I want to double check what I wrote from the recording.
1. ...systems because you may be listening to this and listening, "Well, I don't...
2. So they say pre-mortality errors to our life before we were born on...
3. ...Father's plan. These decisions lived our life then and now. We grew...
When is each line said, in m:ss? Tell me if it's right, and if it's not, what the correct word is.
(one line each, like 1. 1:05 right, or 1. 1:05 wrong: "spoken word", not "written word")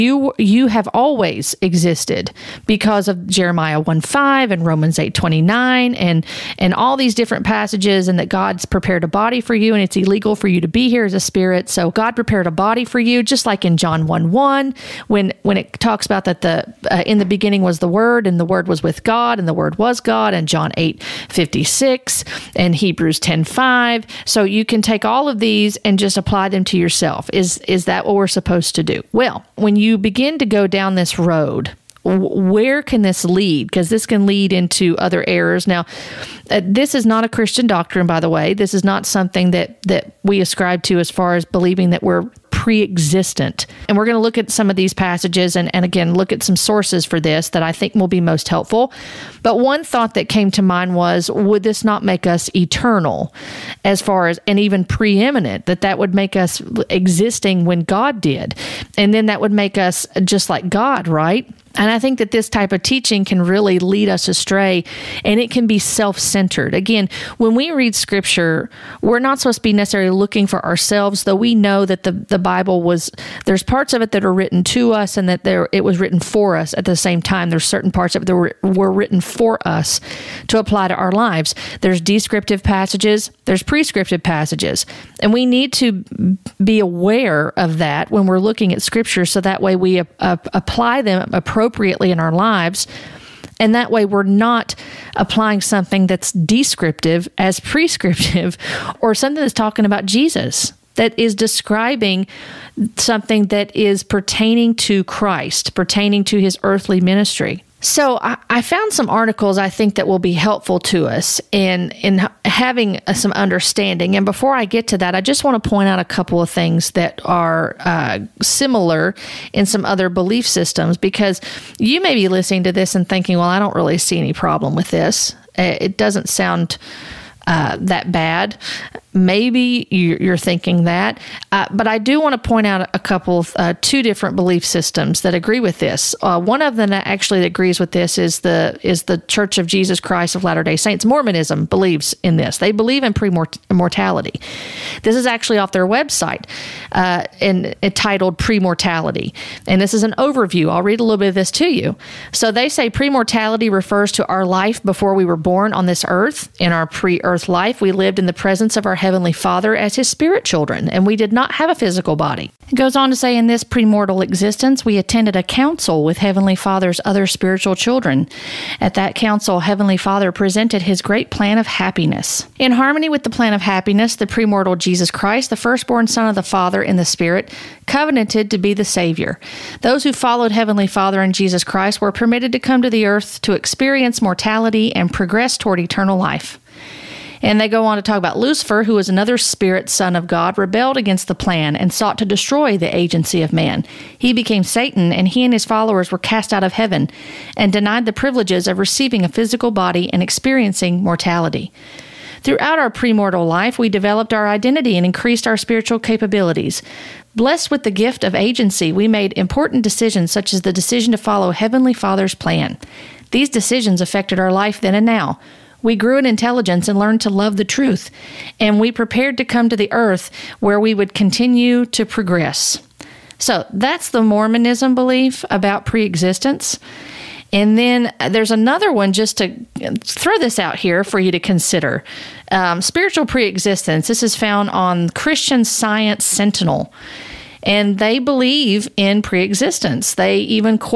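1. 2:00 wrong: "thinking", not "listening"
2. 2:32 wrong: "refers", not "errors"
3. 3:31 wrong: "affected", not "lived".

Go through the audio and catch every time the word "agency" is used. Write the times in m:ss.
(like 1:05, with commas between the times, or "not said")
3:12, 3:28.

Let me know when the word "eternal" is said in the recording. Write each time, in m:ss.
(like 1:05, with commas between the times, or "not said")
0:52, 3:05.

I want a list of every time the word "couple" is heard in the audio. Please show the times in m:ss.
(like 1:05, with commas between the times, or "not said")
1:56, 2:12.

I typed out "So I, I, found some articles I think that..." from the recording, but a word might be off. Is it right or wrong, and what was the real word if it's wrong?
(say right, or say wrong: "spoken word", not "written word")
right.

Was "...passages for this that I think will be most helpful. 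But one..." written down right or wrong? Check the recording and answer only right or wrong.
wrong.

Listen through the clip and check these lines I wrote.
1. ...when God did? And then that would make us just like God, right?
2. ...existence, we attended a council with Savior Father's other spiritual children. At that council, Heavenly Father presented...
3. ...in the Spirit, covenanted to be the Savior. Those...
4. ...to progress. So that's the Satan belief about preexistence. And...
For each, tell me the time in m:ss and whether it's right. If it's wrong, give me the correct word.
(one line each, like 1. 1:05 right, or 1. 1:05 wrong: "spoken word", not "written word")
1. 0:57 right
2. 2:44 wrong: "Heavenly", not "Savior"
3. 2:56 right
4. 3:41 wrong: "Mormonism", not "Satan".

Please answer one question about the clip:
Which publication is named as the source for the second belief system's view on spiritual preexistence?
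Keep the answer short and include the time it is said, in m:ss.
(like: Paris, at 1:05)
Christian Science Sentinel, at 3:55.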